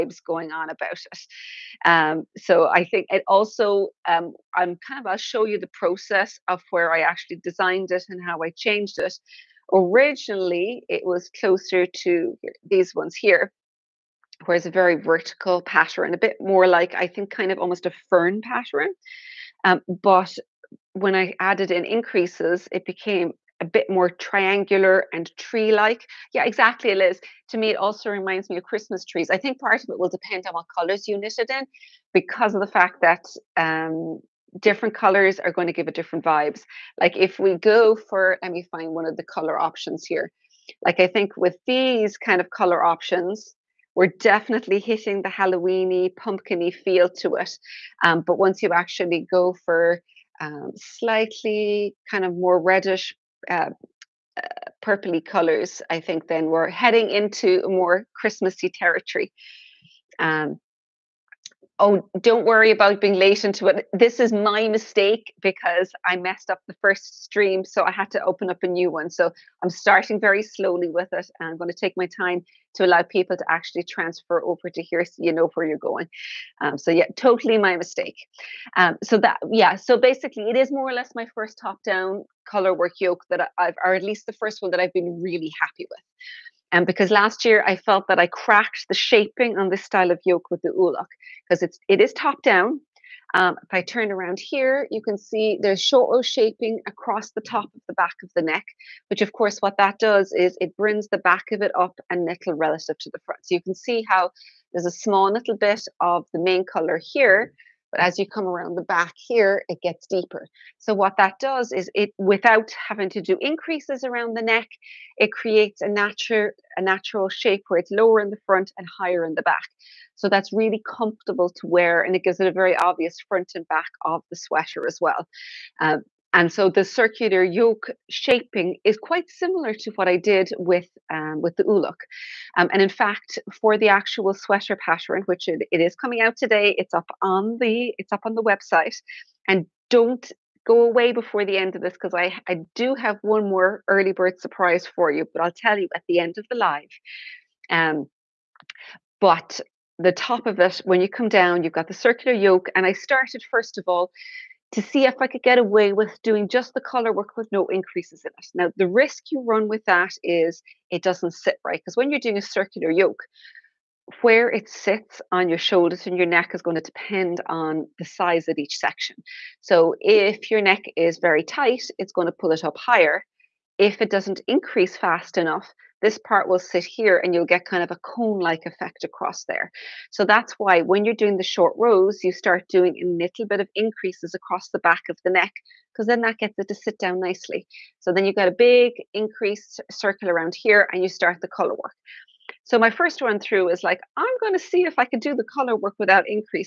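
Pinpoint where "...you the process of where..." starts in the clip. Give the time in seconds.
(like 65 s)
5 s.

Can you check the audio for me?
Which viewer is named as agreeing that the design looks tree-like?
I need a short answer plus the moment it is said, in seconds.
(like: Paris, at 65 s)
Liz, at 26 s.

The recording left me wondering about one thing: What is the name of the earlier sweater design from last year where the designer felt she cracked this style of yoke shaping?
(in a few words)
Ulok.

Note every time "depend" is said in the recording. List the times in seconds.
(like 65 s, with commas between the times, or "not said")
30 s, 166 s.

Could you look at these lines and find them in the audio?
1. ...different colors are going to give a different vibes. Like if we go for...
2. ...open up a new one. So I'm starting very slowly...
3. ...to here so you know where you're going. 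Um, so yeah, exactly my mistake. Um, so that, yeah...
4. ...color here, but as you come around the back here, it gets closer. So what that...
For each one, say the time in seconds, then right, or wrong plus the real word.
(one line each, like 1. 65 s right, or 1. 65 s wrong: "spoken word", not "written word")
1. 34 s right
2. 68 s right
3. 74 s wrong: "totally", not "exactly"
4. 106 s wrong: "deeper", not "closer".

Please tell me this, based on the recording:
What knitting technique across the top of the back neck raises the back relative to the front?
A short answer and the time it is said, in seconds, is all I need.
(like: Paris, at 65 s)
Short row shaping, at 95 s.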